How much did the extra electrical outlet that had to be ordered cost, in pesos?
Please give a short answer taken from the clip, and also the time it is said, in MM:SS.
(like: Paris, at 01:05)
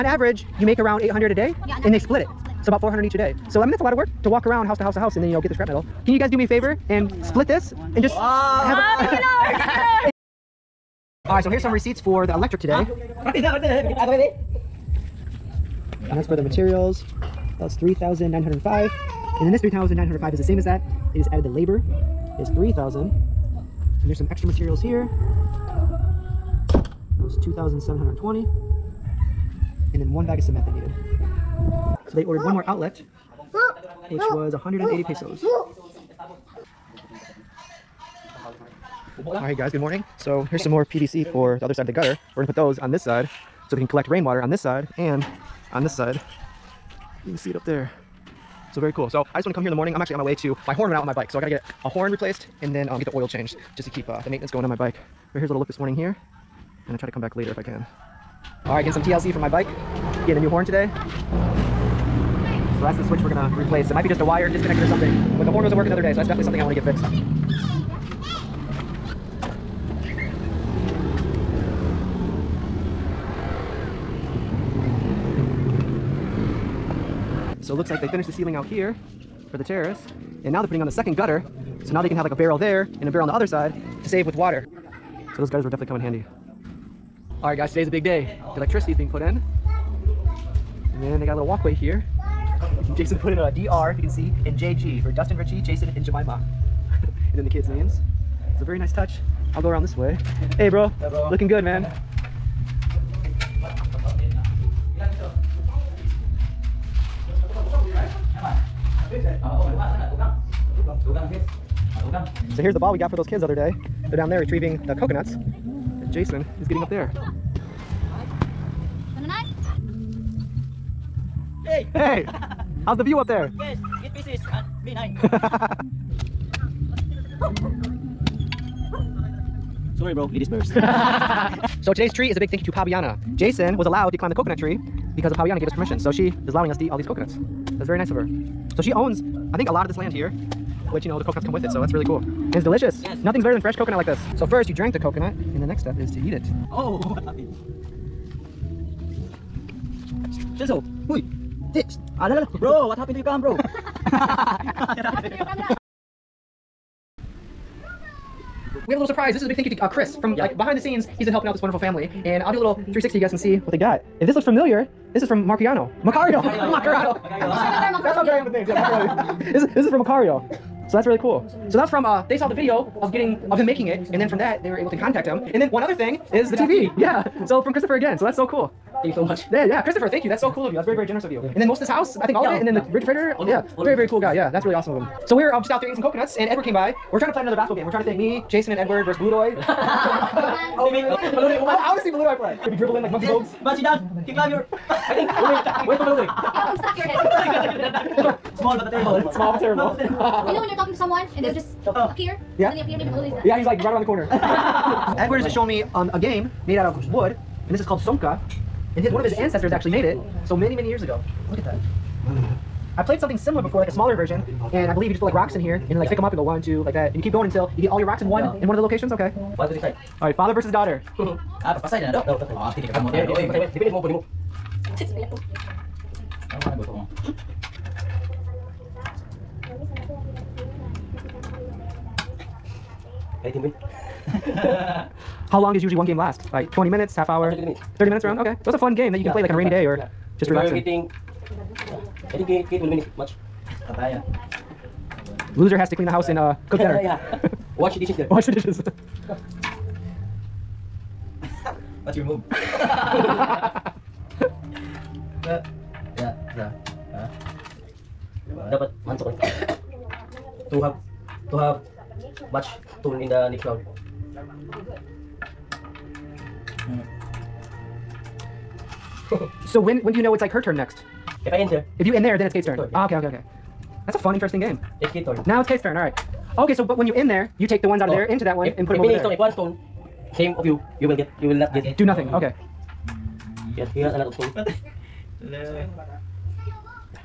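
180 pesos, at 00:34.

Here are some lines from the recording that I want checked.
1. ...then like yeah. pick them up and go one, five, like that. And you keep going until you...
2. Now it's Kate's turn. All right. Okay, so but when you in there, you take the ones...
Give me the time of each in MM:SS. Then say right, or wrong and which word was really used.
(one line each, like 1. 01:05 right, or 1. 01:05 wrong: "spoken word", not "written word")
1. 03:35 wrong: "two", not "five"
2. 04:35 right.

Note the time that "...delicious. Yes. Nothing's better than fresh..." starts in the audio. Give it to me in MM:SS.
02:22.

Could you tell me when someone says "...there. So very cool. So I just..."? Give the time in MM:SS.
00:47.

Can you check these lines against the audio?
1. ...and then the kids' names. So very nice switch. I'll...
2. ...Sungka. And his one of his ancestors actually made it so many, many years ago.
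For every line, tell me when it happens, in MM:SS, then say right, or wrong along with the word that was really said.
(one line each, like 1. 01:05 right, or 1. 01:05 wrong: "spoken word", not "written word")
1. 01:37 wrong: "touch", not "switch"
2. 03:27 right.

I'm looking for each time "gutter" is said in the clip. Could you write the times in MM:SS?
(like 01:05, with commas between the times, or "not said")
00:41, 01:21, 01:25.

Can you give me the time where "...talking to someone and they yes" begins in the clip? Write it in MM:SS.
03:20.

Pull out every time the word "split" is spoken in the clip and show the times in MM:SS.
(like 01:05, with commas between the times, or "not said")
00:01, 00:07.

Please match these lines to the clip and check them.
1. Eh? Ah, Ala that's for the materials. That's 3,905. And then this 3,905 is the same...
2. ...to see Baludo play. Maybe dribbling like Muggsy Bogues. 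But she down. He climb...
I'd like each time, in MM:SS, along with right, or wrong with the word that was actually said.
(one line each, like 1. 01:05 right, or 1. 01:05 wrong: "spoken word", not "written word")
1. 00:12 wrong: "And", not "Ala"
2. 03:11 right.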